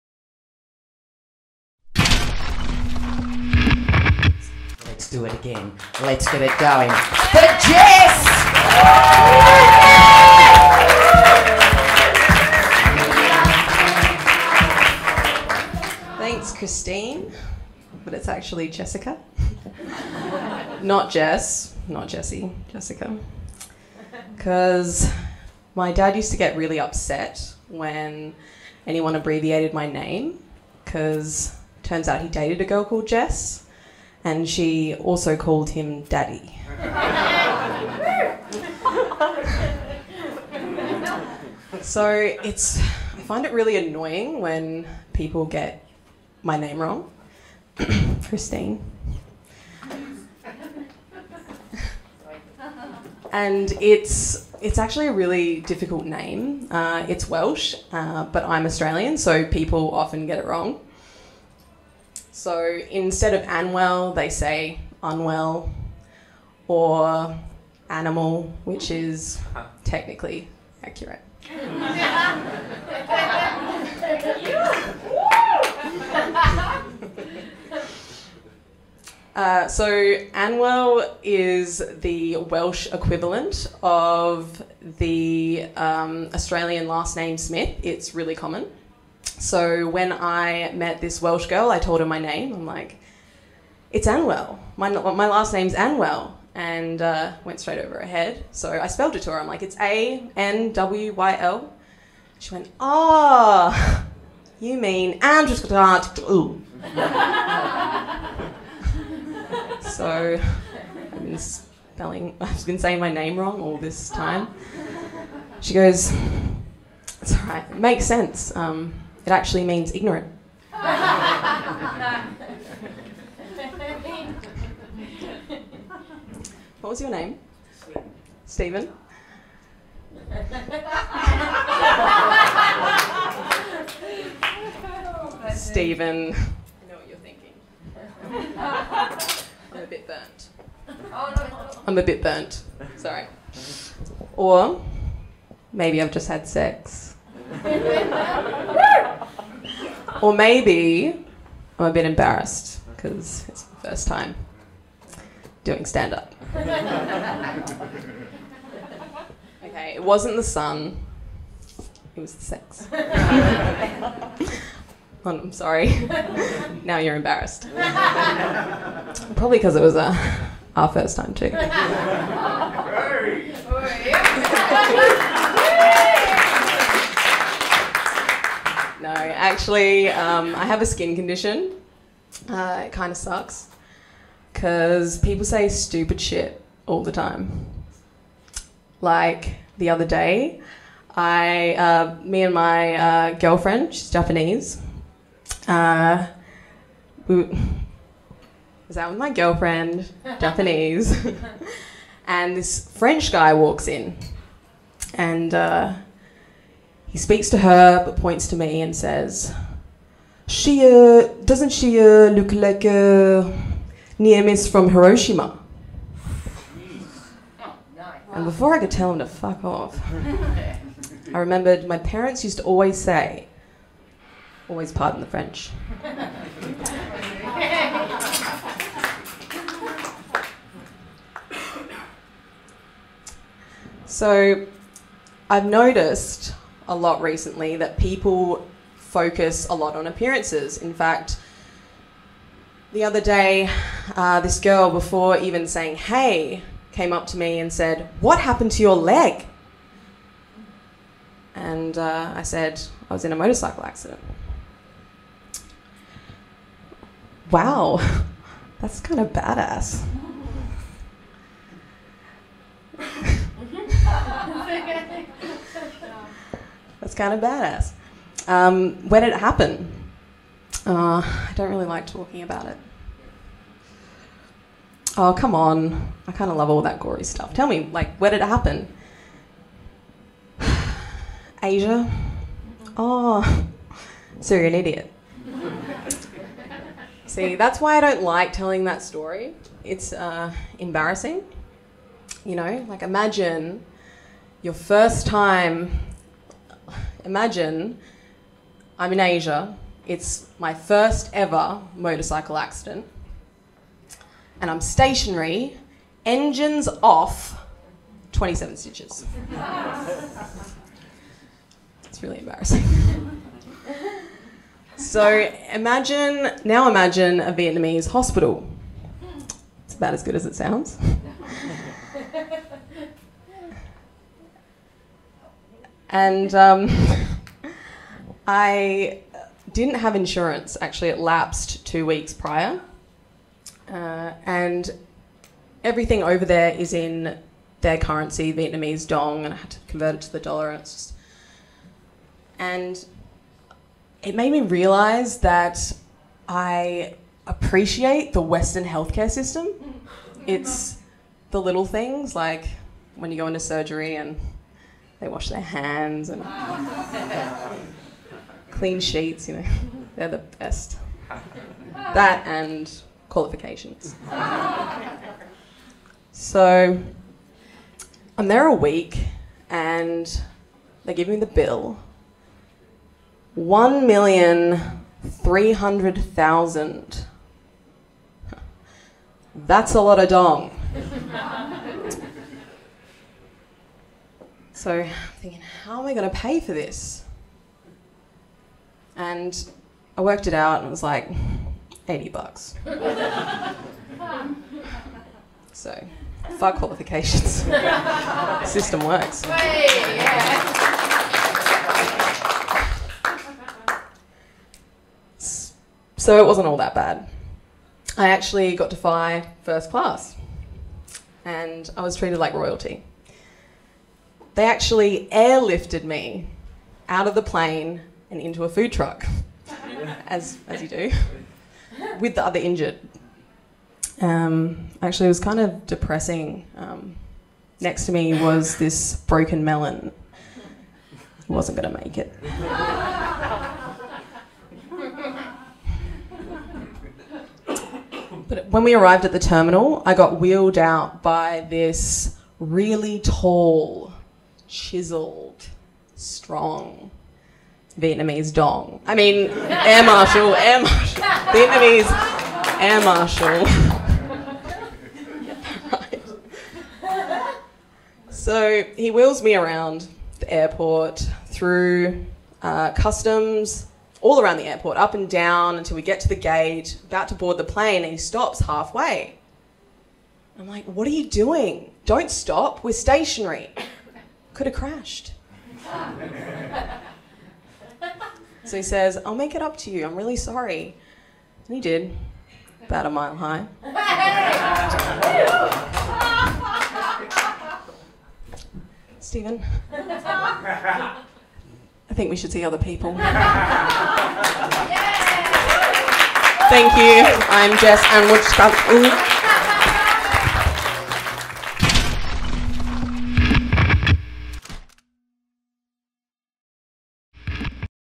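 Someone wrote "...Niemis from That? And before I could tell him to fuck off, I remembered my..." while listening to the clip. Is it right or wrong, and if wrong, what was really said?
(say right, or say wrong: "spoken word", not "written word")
wrong: "Hiroshima", not "That".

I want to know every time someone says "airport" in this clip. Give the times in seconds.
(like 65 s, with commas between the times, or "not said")
460 s, 464 s.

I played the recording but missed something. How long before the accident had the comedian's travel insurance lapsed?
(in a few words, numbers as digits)
two weeks.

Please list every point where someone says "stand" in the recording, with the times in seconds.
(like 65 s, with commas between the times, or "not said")
155 s.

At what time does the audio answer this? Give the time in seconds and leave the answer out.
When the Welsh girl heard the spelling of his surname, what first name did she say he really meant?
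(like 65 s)
105 s.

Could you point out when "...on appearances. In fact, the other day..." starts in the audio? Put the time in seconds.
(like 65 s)
239 s.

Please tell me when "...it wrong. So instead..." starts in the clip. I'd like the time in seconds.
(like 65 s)
60 s.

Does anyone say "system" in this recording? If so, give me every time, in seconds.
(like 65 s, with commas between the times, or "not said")
349 s, 398 s.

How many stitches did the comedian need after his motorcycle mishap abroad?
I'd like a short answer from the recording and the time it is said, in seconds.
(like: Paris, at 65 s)
27, at 308 s.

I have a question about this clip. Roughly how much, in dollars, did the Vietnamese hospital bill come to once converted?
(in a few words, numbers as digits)
80 bucks.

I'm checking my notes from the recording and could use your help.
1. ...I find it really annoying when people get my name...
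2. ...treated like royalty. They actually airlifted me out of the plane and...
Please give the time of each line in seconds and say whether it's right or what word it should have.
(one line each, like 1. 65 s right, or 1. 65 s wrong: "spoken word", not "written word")
1. 42 s right
2. 412 s right.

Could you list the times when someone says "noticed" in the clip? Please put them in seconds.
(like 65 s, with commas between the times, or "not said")
235 s.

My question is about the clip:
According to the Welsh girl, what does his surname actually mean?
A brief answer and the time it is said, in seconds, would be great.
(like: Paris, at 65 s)
ignorant, at 119 s.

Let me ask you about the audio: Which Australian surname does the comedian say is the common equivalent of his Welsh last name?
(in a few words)
Smith.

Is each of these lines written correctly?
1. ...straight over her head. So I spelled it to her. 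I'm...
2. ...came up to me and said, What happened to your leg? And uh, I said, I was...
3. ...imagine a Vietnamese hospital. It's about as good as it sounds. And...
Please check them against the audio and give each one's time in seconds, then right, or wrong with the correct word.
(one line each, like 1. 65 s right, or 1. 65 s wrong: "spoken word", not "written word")
1. 97 s right
2. 246 s right
3. 316 s right.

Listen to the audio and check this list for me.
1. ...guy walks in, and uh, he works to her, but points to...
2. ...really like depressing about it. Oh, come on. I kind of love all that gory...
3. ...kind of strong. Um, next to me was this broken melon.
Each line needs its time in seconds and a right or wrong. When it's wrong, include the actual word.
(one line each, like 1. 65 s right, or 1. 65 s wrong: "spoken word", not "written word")
1. 203 s wrong: "speaks", not "works"
2. 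271 s wrong: "talking", not "depressing"
3. 425 s wrong: "depressing", not "strong".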